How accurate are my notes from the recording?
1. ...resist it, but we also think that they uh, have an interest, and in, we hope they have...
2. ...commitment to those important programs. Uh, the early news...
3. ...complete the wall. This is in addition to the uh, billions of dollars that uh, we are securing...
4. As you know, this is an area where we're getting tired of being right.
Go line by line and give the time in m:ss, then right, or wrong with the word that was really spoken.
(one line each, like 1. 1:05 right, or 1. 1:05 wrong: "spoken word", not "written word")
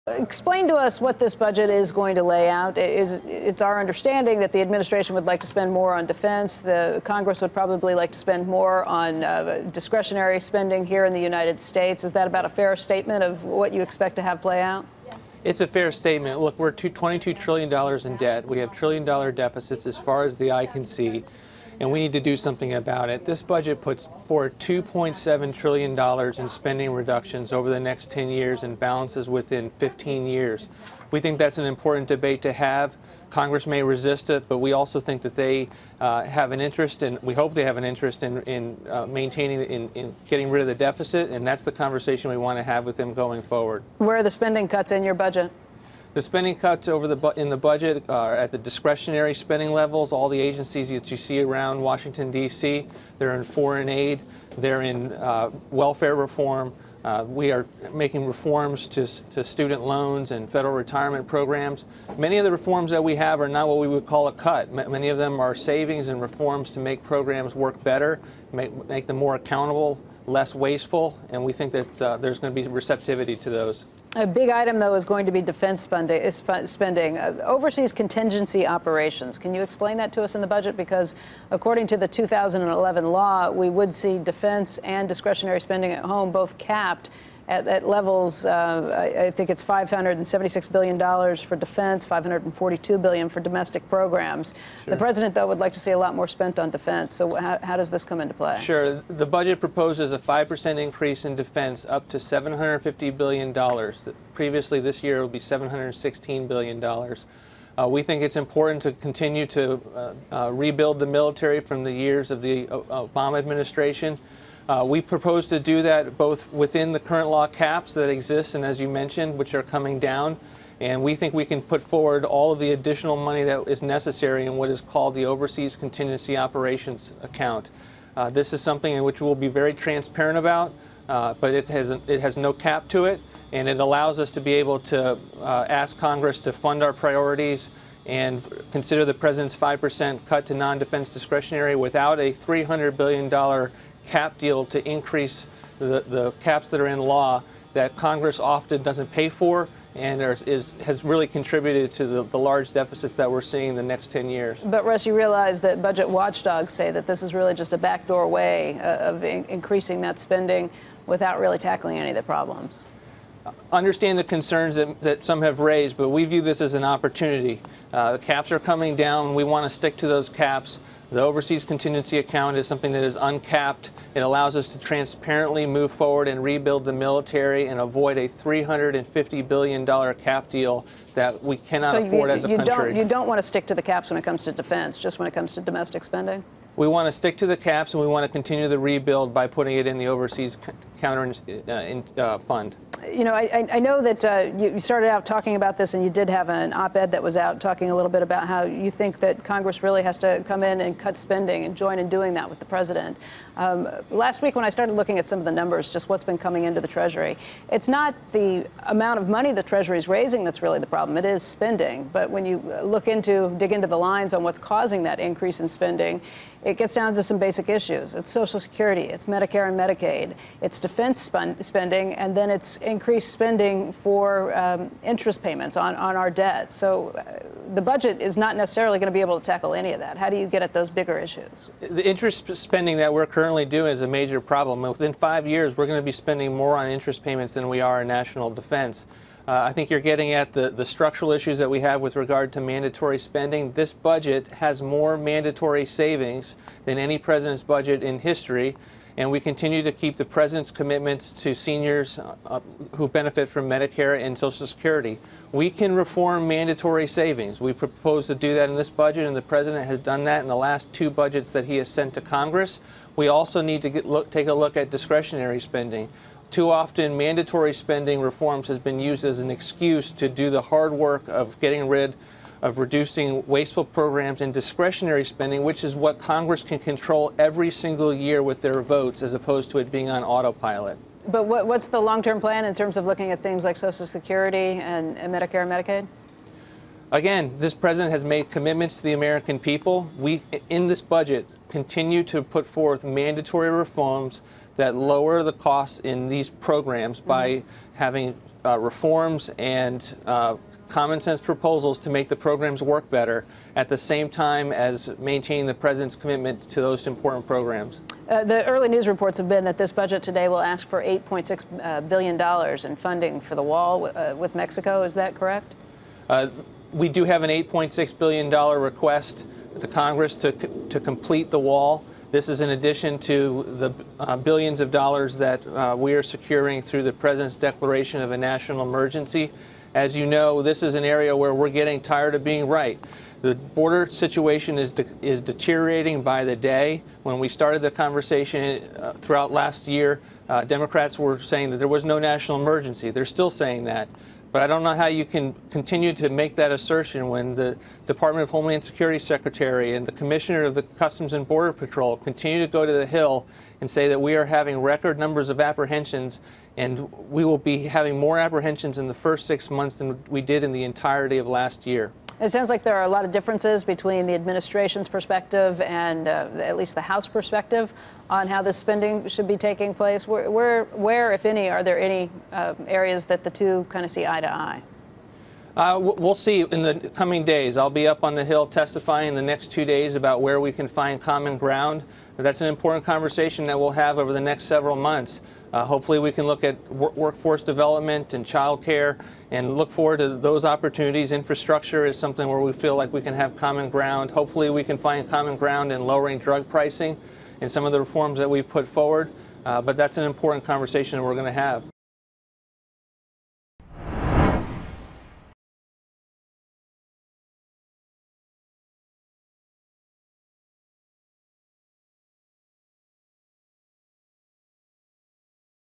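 1. 0:33 right
2. 5:06 right
3. 5:20 right
4. 5:29 right.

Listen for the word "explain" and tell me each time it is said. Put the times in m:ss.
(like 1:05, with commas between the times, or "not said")
0:00, 1:19.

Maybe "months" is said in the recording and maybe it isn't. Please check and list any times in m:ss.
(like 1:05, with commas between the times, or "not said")
5:59, 6:24.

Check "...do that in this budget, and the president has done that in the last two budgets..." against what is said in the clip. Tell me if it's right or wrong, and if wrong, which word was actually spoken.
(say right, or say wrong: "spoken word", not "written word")
right.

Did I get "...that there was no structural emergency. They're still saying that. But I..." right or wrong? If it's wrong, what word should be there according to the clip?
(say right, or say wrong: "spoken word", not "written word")
wrong: "national", not "structural".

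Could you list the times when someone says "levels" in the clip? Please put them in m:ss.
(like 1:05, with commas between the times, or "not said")
0:49, 1:27.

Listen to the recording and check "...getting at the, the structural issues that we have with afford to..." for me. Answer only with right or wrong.
wrong.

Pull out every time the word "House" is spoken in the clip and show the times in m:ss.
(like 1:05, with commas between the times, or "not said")
6:07.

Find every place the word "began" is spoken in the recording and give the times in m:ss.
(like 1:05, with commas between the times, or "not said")
not said.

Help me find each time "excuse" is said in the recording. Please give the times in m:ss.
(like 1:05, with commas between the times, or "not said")
4:29.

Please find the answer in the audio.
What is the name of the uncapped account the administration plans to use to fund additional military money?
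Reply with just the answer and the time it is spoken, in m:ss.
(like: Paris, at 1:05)
Overseas Contingency Operations Account, at 2:05.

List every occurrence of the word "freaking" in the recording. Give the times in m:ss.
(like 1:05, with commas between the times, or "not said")
not said.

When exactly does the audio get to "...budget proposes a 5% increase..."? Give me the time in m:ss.
1:39.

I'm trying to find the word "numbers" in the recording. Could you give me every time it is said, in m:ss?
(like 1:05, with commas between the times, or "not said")
3:25, 5:55.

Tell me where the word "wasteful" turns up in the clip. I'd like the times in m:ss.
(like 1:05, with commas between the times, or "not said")
1:10, 4:33.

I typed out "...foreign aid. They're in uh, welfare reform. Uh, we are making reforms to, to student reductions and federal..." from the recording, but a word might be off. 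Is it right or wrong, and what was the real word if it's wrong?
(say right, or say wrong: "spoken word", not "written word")
wrong: "loans", not "reductions".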